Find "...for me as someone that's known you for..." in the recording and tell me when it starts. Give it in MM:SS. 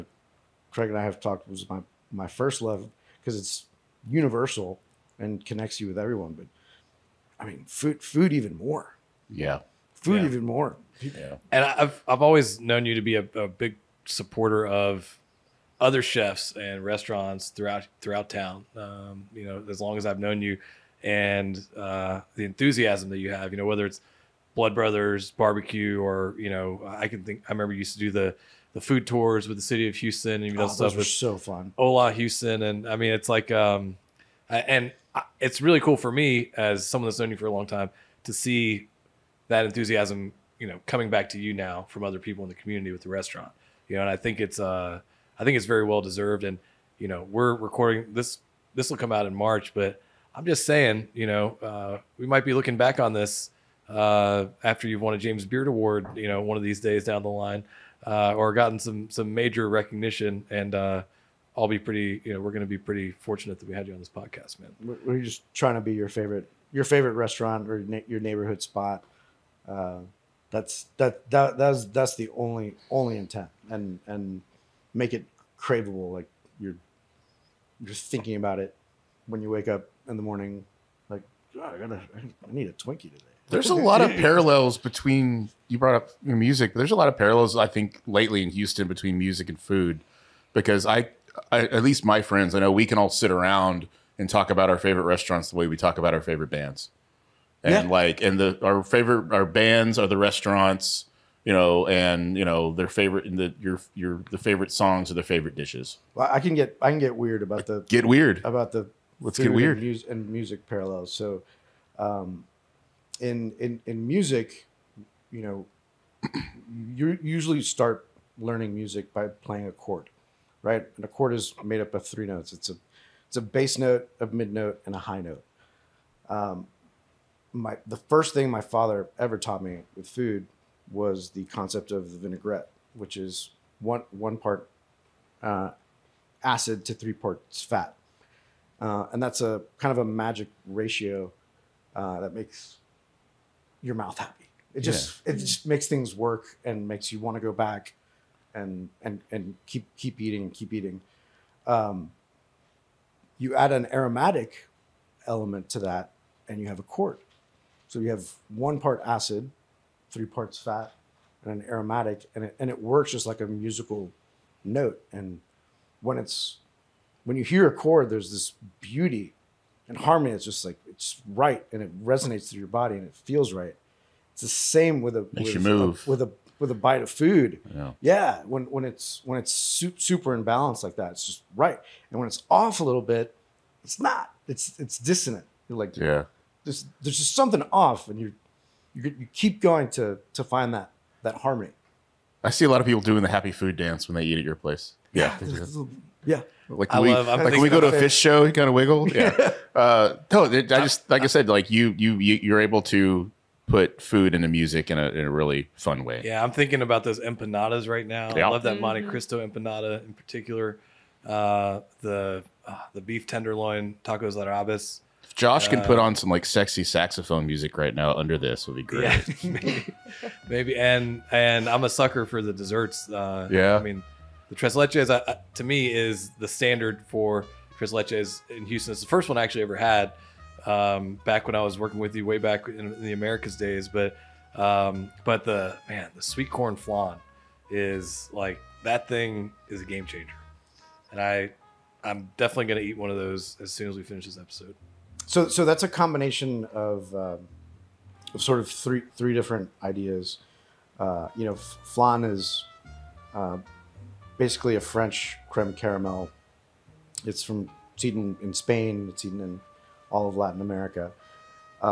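00:35.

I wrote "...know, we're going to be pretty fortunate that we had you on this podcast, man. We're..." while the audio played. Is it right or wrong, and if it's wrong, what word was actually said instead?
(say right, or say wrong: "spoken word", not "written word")
right.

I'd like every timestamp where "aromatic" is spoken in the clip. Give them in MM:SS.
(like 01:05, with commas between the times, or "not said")
02:33, 02:41.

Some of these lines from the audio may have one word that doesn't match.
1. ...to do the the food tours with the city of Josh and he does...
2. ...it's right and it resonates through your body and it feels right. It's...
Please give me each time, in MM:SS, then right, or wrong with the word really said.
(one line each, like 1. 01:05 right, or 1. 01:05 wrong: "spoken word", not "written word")
1. 00:27 wrong: "Houston", not "Josh"
2. 02:50 right.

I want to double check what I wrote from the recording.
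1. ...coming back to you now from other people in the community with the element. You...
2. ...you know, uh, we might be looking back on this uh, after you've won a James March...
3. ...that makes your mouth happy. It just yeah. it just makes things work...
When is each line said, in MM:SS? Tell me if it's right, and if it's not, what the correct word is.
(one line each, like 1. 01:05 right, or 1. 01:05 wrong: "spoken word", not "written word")
1. 00:40 wrong: "restaurant", not "element"
2. 00:51 wrong: "Beard", not "March"
3. 02:22 right.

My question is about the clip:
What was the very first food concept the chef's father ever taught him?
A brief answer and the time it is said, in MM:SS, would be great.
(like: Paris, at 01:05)
The vinaigrette, at 02:12.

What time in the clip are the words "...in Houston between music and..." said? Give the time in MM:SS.
01:28.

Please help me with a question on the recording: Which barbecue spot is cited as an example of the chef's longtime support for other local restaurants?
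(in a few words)
Blood Brothers barbecue.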